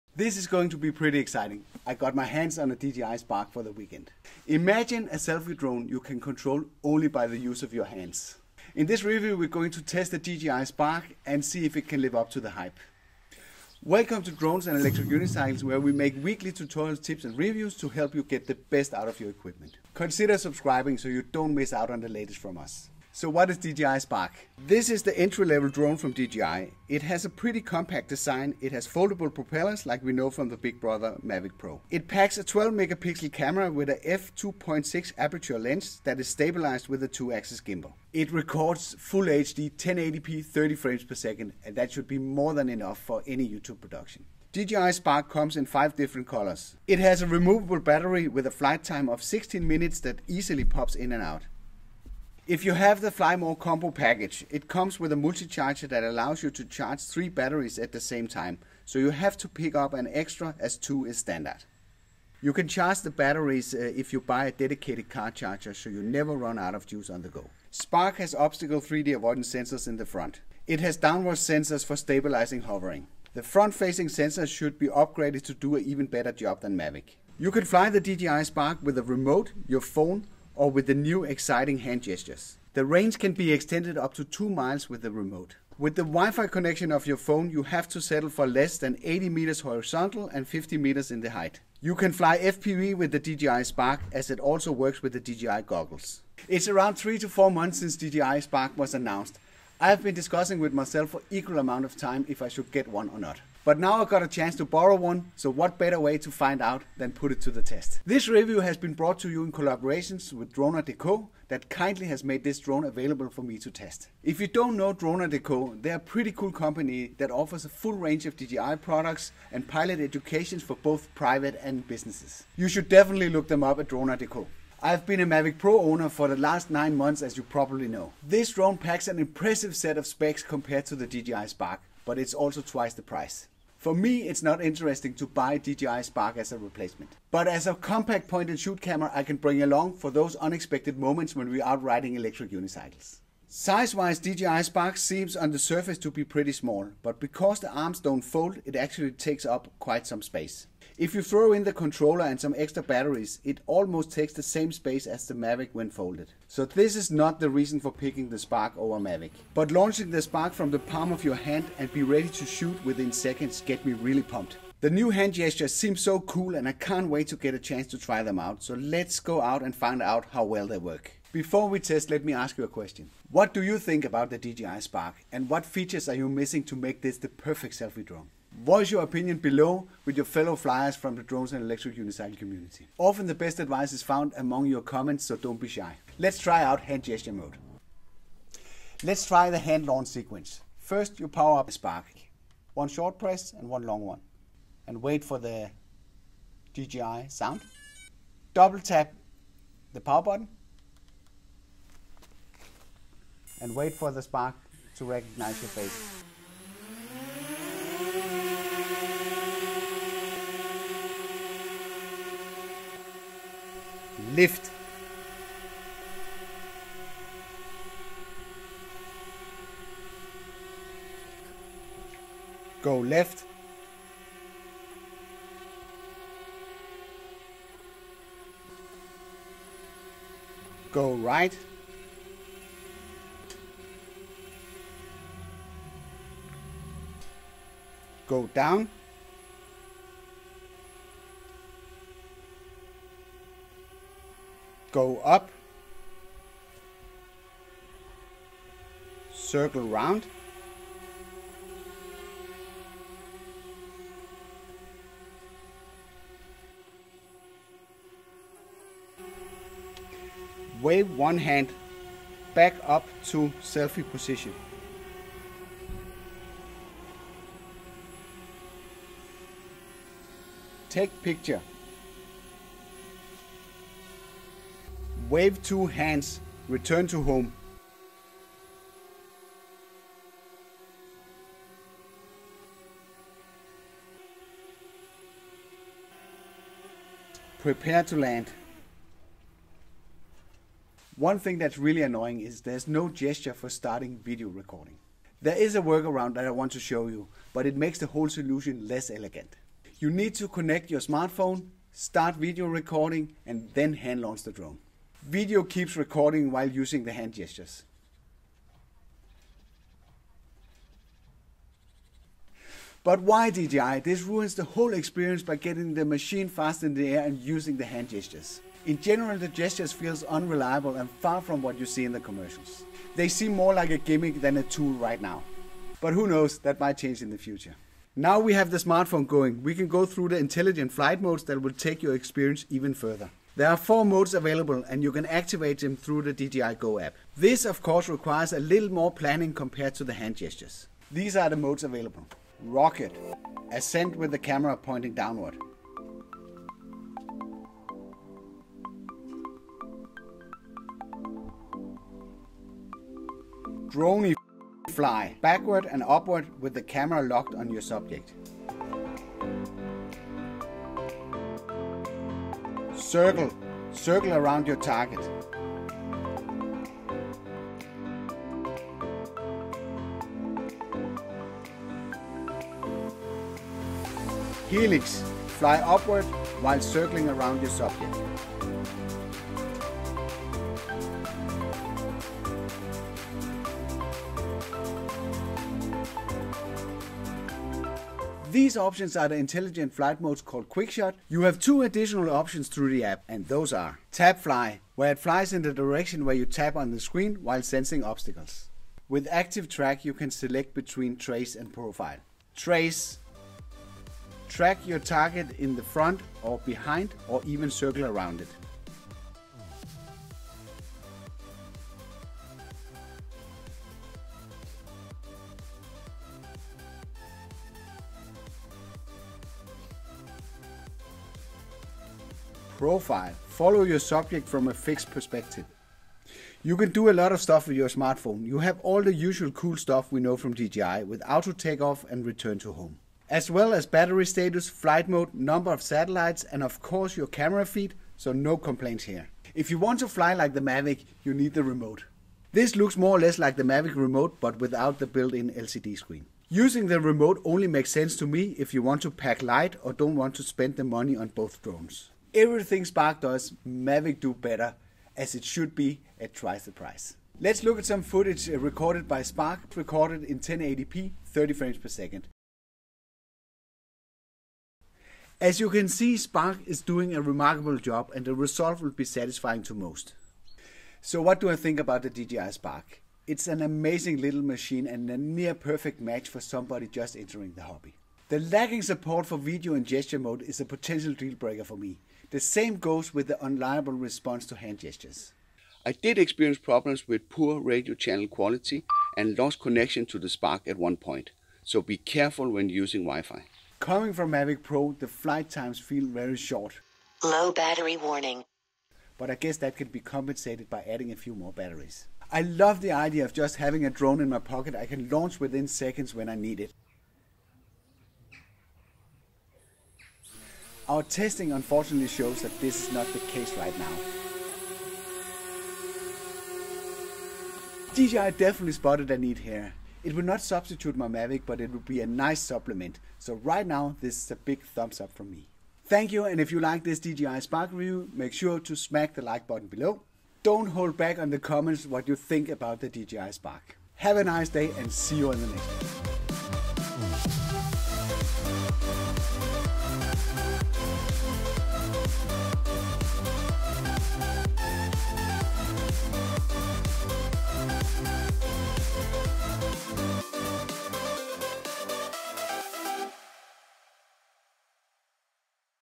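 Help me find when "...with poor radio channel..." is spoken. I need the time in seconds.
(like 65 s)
487 s.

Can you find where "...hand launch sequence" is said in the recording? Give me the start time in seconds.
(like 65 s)
189 s.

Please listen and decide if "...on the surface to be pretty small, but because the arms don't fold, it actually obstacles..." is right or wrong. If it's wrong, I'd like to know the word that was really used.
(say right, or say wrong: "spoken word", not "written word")
wrong: "takes", not "obstacles".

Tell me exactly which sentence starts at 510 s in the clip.
Our testing unfortunately shows that this is not the case right now.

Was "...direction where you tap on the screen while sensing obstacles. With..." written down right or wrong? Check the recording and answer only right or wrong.
right.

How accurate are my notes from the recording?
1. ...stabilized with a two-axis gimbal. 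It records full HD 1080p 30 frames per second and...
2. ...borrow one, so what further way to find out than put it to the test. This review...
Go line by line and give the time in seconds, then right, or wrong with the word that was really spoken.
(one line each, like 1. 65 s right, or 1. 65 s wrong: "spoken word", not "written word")
1. 36 s right
2. 104 s wrong: "better", not "further".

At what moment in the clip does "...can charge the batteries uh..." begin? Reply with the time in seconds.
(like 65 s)
62 s.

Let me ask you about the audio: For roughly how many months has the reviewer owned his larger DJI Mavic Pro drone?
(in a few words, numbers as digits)
9 months.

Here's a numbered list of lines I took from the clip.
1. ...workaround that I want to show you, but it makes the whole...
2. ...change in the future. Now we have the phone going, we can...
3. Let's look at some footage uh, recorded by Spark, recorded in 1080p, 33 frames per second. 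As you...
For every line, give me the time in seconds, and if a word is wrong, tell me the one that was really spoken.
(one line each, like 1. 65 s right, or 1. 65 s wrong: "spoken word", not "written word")
1. 295 s right
2. 326 s wrong: "smartphone", not "phone"
3. 457 s wrong: "30", not "33".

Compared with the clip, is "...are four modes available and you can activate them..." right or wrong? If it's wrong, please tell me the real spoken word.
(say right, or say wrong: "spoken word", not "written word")
right.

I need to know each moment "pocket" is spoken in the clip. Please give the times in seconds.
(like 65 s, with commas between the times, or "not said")
504 s.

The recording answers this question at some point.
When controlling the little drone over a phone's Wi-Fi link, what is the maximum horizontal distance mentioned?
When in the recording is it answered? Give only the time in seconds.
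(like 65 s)
89 s.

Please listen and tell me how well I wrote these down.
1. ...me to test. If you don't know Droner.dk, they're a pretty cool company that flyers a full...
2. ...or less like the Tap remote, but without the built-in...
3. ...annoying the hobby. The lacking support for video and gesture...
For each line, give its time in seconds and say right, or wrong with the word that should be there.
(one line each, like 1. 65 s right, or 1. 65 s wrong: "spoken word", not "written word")
1. 113 s wrong: "offers", not "flyers"
2. 443 s wrong: "Mavic", not "Tap"
3. 477 s wrong: "entering", not "annoying".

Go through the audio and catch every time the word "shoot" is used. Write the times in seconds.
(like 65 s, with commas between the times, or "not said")
138 s, 162 s.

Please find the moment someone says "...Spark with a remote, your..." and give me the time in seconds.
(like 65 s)
78 s.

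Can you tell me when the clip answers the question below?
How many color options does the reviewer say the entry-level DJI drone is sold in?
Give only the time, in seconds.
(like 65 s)
45 s.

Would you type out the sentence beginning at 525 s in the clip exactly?
Thank you, and if you like this DJI Spark review, make sure to smack the like button below.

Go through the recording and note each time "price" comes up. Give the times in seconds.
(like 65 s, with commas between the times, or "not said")
133 s, 456 s.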